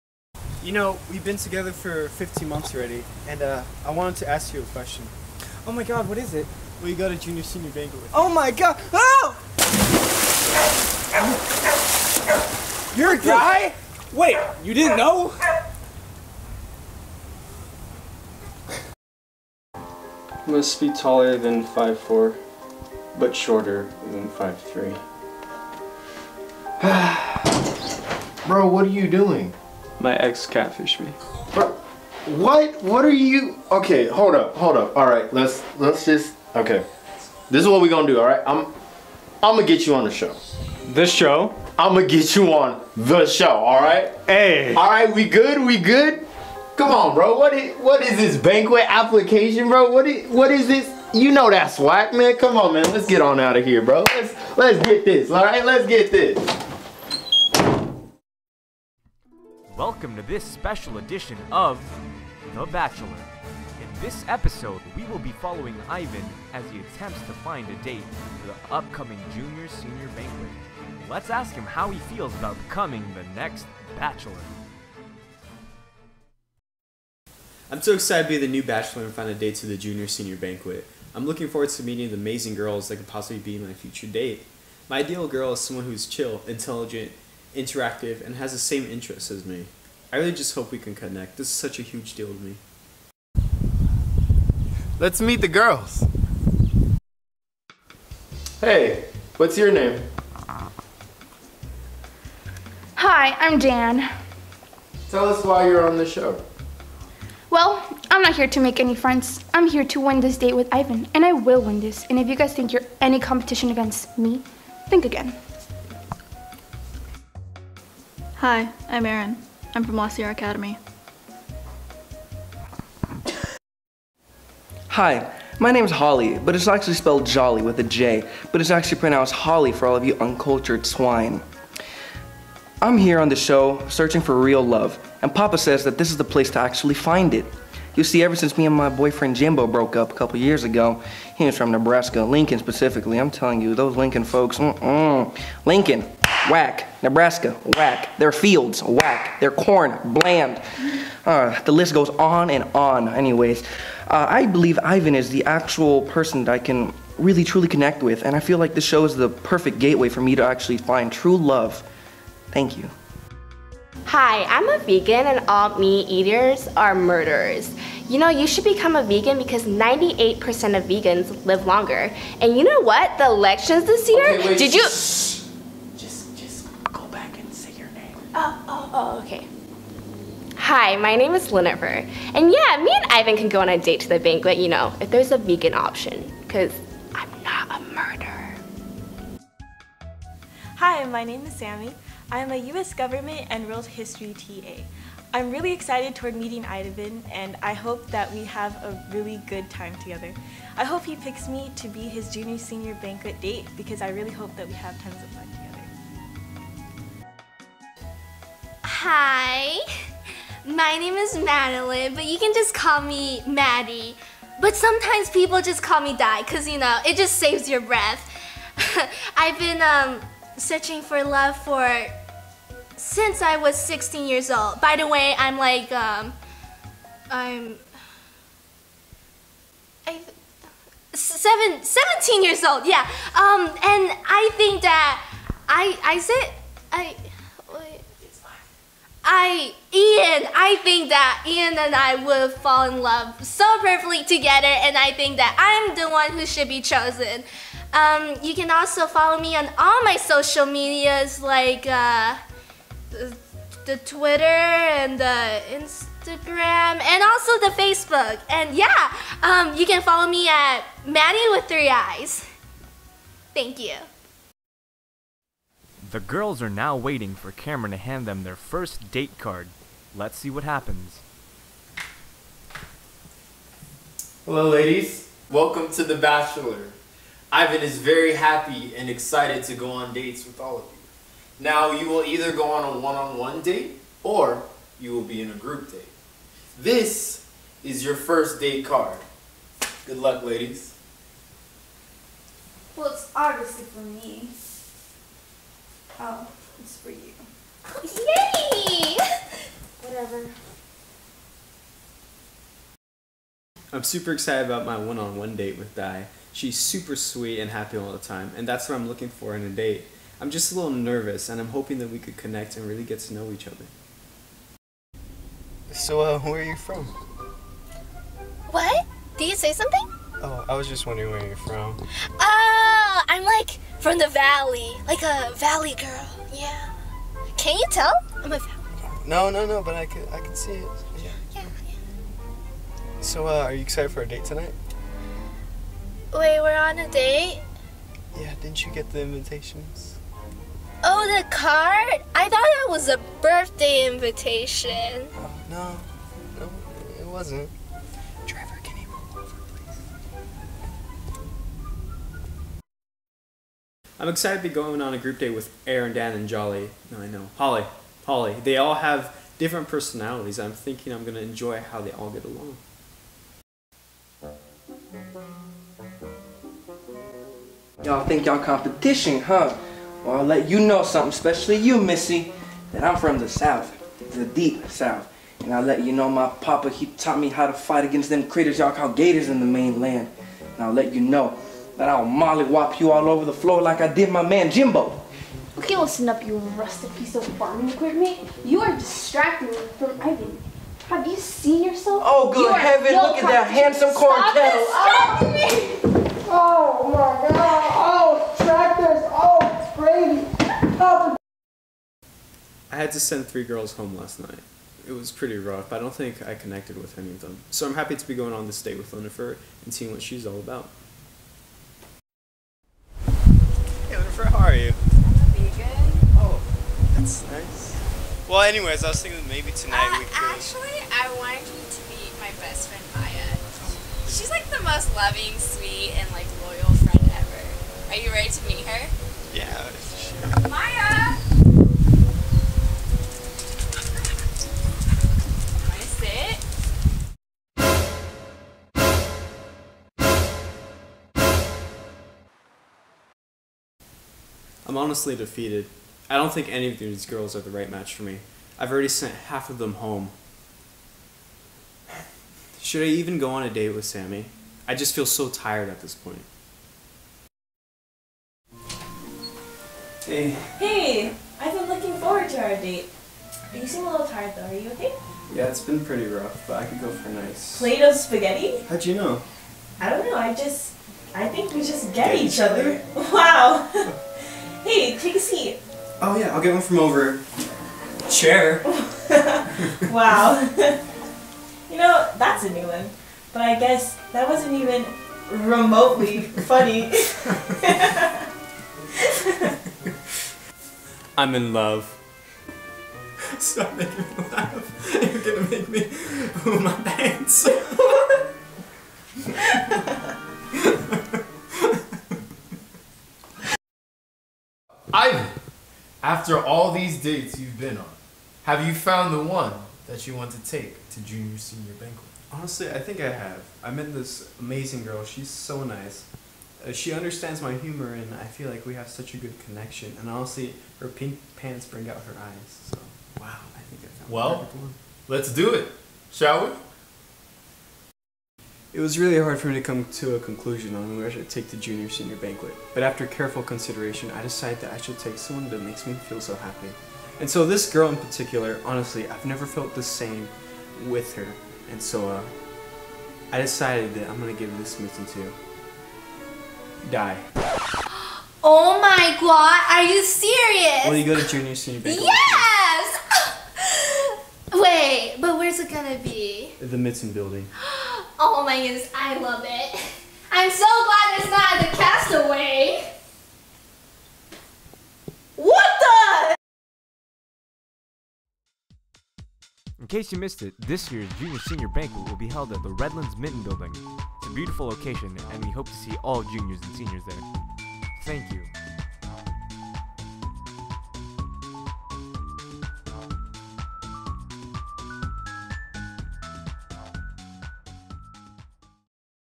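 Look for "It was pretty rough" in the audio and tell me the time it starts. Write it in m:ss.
6:45.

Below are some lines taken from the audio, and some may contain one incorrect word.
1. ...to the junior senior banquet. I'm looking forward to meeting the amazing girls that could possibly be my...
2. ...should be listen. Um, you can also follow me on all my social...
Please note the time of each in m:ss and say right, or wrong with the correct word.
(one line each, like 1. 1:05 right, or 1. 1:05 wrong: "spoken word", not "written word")
1. 1:19 right
2. 4:06 wrong: "chosen", not "listen".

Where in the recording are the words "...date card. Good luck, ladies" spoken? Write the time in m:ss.
4:48.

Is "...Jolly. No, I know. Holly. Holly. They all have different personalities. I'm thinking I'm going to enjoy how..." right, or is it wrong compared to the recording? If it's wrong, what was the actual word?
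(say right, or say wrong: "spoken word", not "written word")
right.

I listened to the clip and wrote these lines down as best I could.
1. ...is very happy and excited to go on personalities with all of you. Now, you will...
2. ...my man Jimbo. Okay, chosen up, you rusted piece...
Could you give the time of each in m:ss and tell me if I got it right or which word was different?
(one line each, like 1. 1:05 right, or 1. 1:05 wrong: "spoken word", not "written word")
1. 4:37 wrong: "dates", not "personalities"
2. 6:24 wrong: "listen", not "chosen".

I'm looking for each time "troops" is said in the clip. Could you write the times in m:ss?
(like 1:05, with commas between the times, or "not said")
not said.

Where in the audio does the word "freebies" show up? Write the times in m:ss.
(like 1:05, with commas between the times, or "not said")
not said.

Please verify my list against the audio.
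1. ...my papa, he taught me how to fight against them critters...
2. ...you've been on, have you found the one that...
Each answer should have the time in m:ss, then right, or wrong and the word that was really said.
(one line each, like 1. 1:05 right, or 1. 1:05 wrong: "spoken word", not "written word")
1. 6:16 right
2. 8:27 right.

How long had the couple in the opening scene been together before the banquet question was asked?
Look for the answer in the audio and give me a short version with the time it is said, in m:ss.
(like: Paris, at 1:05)
15 months, at 0:02.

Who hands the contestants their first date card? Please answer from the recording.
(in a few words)
Cameron.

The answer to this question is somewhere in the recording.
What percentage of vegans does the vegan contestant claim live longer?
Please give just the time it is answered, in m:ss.
2:49.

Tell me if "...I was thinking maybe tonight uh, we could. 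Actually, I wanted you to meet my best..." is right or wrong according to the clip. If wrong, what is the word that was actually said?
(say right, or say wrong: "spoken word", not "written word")
right.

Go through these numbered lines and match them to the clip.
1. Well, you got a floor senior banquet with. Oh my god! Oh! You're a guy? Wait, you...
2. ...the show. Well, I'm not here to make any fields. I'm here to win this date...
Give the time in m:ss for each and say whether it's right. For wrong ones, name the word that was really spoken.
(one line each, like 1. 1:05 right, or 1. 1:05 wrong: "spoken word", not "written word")
1. 0:06 wrong: "junior", not "floor"
2. 1:45 wrong: "friends", not "fields".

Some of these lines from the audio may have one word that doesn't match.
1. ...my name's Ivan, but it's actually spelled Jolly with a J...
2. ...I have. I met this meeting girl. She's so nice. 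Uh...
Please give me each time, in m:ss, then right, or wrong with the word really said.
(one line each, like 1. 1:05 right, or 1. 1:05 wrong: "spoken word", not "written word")
1. 2:05 wrong: "Holly", not "Ivan"
2. 8:33 wrong: "amazing", not "meeting".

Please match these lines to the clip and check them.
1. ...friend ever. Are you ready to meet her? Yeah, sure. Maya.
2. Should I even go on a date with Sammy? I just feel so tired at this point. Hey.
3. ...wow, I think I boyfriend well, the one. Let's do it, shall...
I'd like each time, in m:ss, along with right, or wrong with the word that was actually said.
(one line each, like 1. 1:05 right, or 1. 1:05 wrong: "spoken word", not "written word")
1. 7:07 right
2. 7:32 right
3. 8:43 wrong: "found", not "boyfriend".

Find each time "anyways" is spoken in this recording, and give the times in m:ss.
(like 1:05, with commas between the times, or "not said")
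2:33, 6:58.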